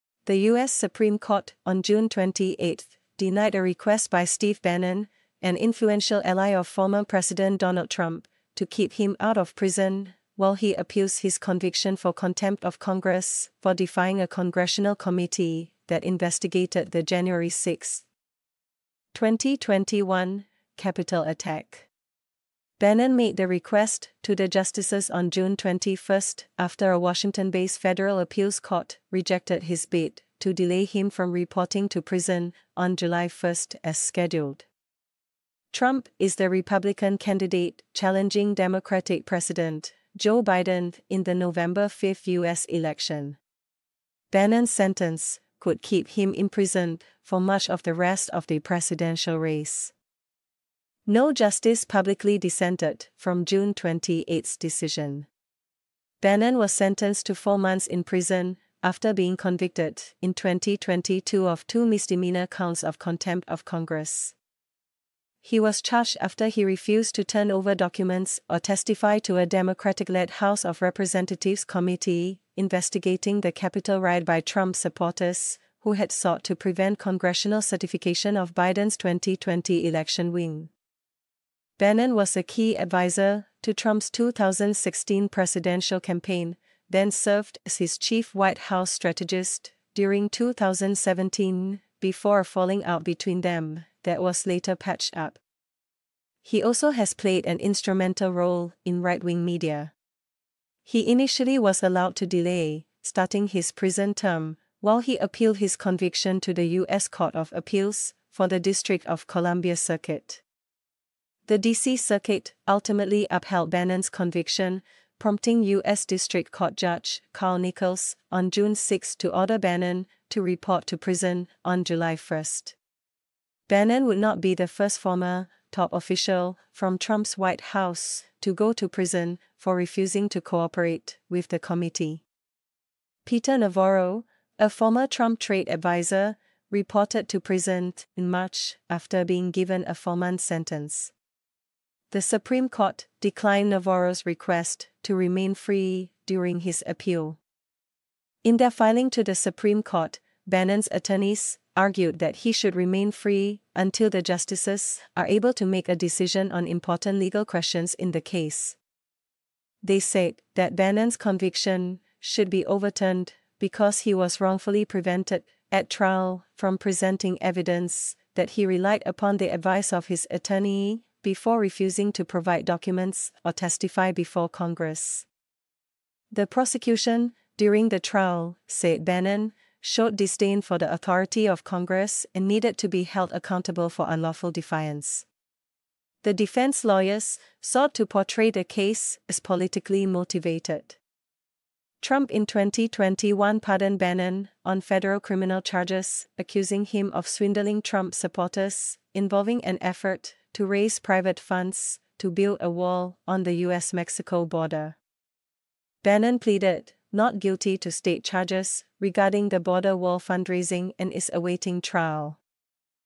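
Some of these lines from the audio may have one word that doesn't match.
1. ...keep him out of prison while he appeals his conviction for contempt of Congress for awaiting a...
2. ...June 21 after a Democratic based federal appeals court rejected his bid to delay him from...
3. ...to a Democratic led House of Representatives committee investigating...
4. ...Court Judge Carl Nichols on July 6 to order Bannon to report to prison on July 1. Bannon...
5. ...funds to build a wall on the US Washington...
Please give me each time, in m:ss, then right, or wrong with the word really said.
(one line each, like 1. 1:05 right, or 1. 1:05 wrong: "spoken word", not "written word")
1. 0:08 wrong: "defying", not "awaiting"
2. 0:25 wrong: "Washington", not "Democratic"
3. 1:09 right
4. 1:56 wrong: "June", not "July"
5. 3:21 wrong: "Mexico", not "Washington".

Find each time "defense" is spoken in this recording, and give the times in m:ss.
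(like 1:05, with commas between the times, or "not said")
3:06.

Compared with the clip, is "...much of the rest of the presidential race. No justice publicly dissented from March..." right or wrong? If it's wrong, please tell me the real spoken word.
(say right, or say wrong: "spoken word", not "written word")
wrong: "June", not "March".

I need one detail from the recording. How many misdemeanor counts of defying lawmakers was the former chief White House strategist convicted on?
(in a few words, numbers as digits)
2.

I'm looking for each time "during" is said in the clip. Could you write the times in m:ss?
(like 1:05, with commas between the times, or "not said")
1:29, 2:26, 2:57.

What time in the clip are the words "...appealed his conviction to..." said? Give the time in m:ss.
1:45.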